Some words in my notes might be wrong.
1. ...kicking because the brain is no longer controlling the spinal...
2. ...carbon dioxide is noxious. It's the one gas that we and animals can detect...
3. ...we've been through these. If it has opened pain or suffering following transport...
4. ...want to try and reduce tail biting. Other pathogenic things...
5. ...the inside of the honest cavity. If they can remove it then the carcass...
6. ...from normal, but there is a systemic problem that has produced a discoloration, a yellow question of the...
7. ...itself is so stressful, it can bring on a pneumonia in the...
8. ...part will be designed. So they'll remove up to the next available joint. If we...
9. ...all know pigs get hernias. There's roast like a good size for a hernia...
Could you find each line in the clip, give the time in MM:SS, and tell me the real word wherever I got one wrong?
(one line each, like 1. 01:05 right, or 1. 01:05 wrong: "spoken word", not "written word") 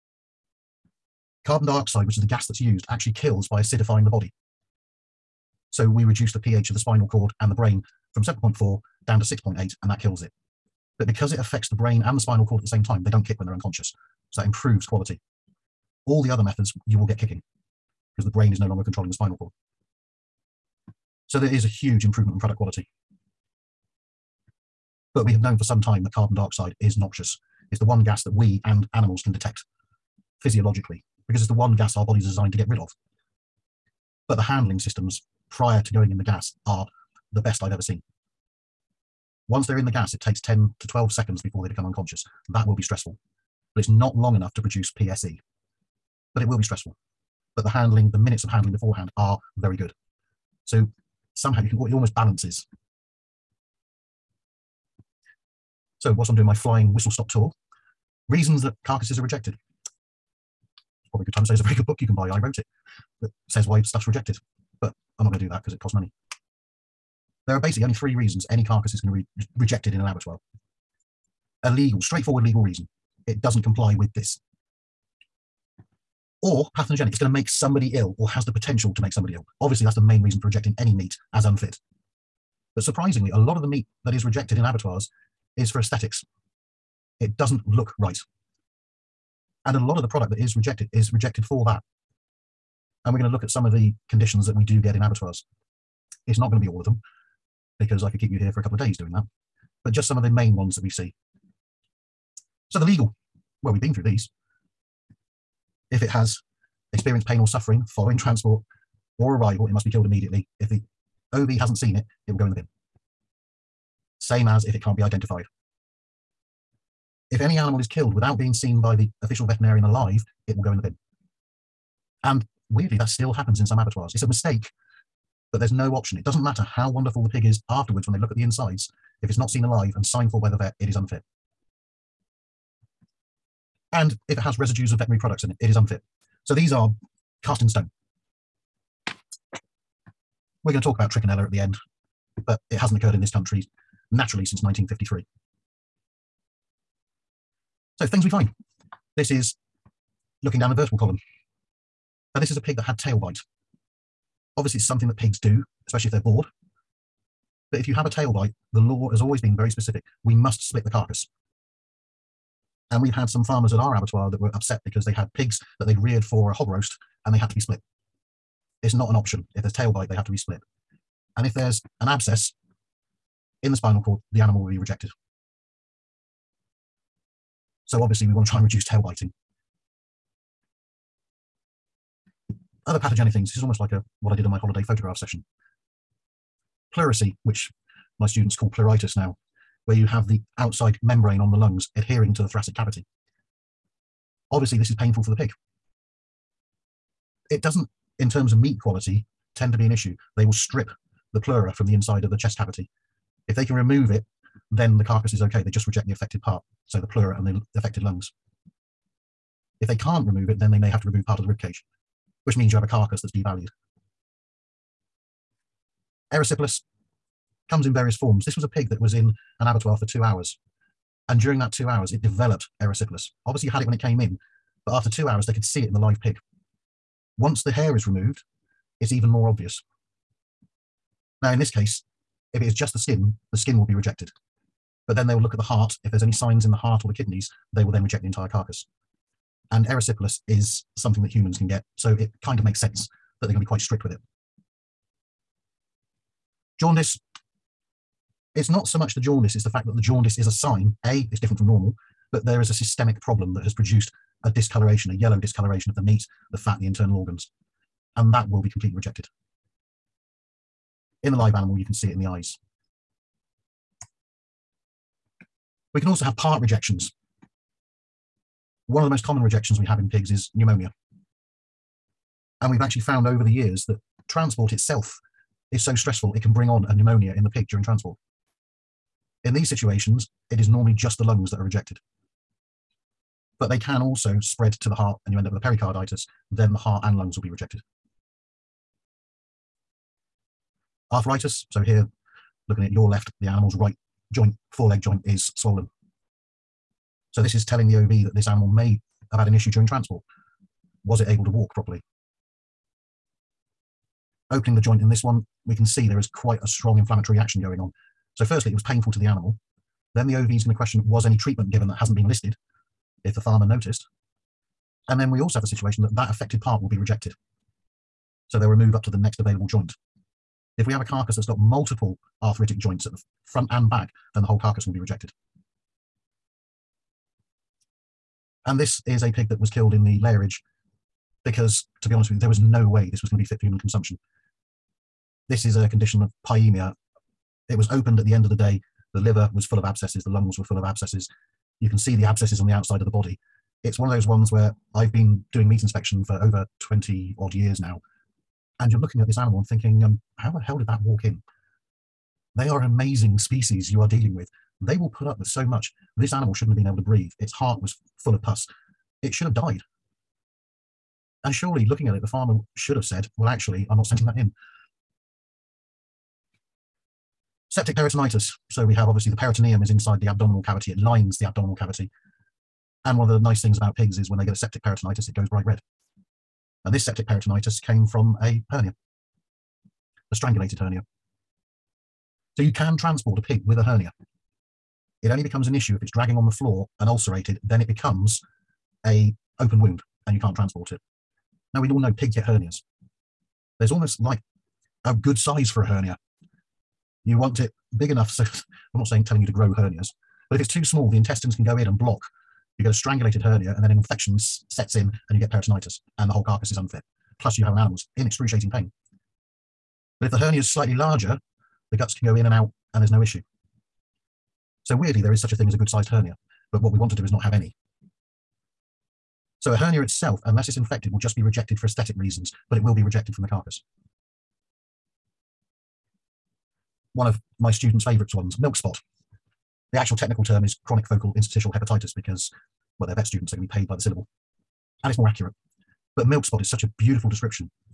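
1. 00:17 right
2. 00:26 right
3. 01:43 wrong: "experienced", not "opened"
4. 02:58 right
5. 03:21 wrong: "chest", not "honest"
6. 04:11 wrong: "discoloration", not "question"
7. 04:34 right
8. 05:16 wrong: "rejected", not "designed"
9. 06:31 wrong: "almost", not "roast".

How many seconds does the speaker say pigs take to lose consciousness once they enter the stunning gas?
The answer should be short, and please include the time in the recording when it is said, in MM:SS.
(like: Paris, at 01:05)
10 to 12 seconds, at 00:40.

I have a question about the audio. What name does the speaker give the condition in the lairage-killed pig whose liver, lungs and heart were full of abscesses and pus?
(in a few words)
pyemia.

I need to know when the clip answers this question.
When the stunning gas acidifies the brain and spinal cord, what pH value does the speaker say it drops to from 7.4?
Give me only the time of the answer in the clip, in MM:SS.
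00:09.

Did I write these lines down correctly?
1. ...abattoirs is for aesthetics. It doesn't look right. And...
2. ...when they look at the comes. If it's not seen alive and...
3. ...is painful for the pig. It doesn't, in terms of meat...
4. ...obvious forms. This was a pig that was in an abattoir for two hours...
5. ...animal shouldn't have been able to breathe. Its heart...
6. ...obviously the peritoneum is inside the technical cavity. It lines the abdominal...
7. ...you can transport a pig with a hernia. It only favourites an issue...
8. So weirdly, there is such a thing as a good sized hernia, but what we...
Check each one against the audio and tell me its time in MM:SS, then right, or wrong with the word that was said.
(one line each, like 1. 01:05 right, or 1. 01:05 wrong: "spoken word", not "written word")
1. 01:24 right
2. 02:08 wrong: "insides", not "comes"
3. 03:14 right
4. 03:37 wrong: "various", not "obvious"
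5. 05:56 right
6. 06:09 wrong: "abdominal", not "technical"
7. 06:22 wrong: "becomes", not "favourites"
8. 06:54 right.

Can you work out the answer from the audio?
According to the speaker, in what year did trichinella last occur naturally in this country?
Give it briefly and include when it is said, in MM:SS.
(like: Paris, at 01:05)
1953, at 02:24.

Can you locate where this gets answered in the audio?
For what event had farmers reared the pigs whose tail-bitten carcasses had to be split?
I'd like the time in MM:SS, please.
02:46.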